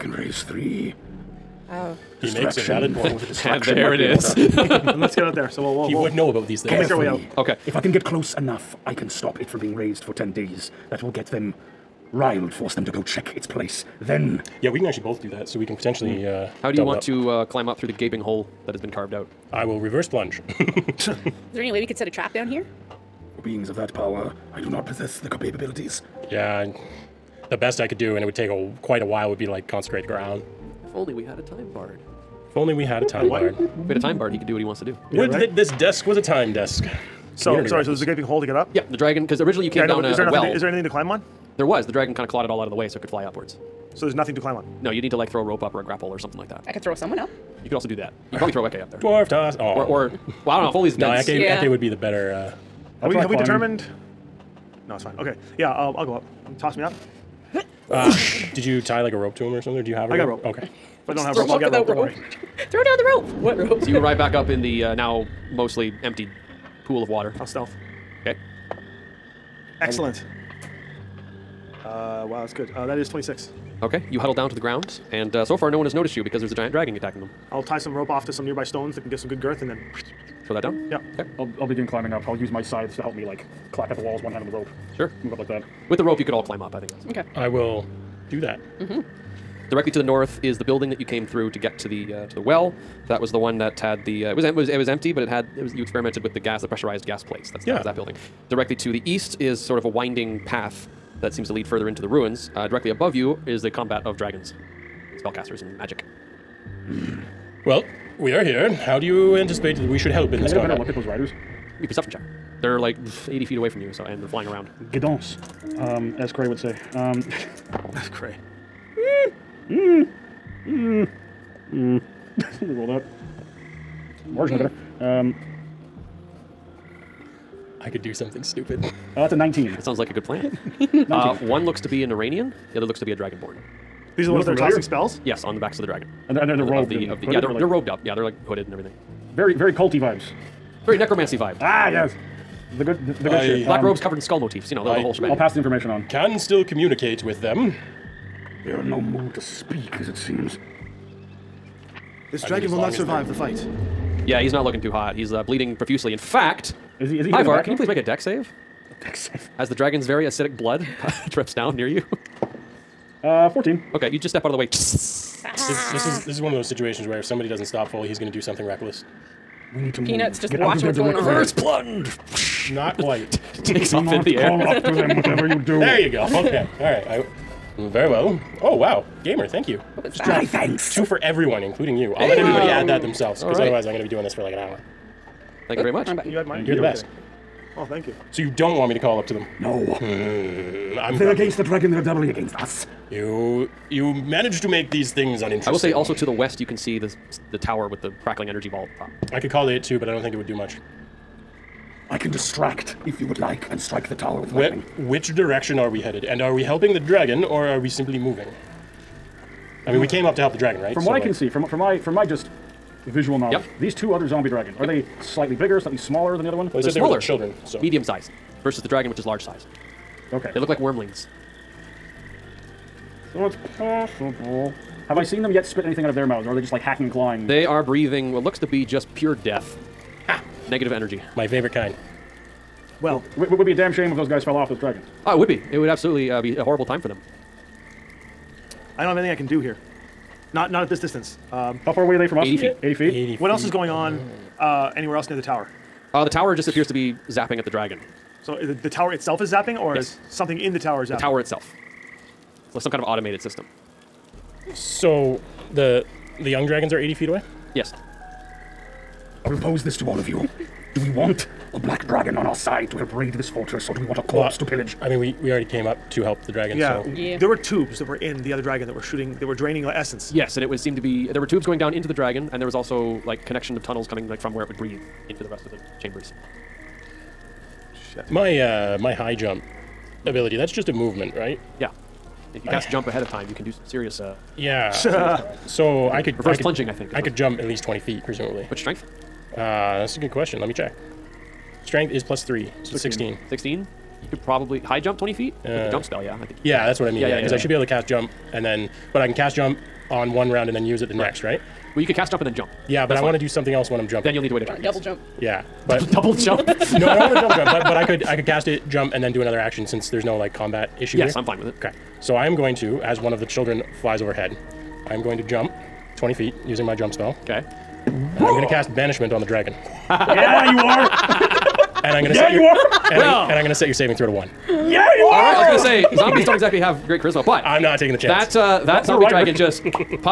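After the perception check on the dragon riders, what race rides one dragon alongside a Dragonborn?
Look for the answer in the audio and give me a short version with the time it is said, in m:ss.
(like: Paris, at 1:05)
Iranian, at 2:12.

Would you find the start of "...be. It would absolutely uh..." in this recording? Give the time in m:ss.
3:55.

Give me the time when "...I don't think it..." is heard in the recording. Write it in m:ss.
3:20.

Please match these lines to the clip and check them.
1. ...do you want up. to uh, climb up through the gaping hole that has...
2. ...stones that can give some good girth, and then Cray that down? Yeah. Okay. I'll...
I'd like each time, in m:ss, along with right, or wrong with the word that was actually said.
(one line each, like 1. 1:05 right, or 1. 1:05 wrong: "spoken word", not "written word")
1. 0:16 right
2. 1:18 wrong: "Throw", not "Cray".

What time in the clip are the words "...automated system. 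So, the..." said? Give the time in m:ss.
4:13.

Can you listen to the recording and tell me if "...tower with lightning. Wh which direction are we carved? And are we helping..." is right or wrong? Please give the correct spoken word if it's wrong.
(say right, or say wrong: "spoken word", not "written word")
wrong: "headed", not "carved".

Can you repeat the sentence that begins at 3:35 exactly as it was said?
they slightly bigger, slightly smaller than the other one?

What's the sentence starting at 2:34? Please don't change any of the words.
Yeah, he's not looking too hot.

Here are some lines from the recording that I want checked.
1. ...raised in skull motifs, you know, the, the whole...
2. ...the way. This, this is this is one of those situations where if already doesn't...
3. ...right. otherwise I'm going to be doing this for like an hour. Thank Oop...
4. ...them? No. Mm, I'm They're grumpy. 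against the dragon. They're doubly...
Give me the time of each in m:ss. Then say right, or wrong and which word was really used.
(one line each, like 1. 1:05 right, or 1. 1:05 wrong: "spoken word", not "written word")
1. 2:24 wrong: "covered", not "raised"
2. 2:44 wrong: "somebody", not "already"
3. 3:03 right
4. 3:09 right.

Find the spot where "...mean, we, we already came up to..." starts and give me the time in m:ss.
4:25.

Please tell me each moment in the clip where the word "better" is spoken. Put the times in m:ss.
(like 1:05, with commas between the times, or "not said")
0:51, 1:50, 2:04.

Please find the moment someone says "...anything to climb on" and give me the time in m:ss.
0:40.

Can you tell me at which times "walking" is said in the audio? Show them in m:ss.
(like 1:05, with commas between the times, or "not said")
not said.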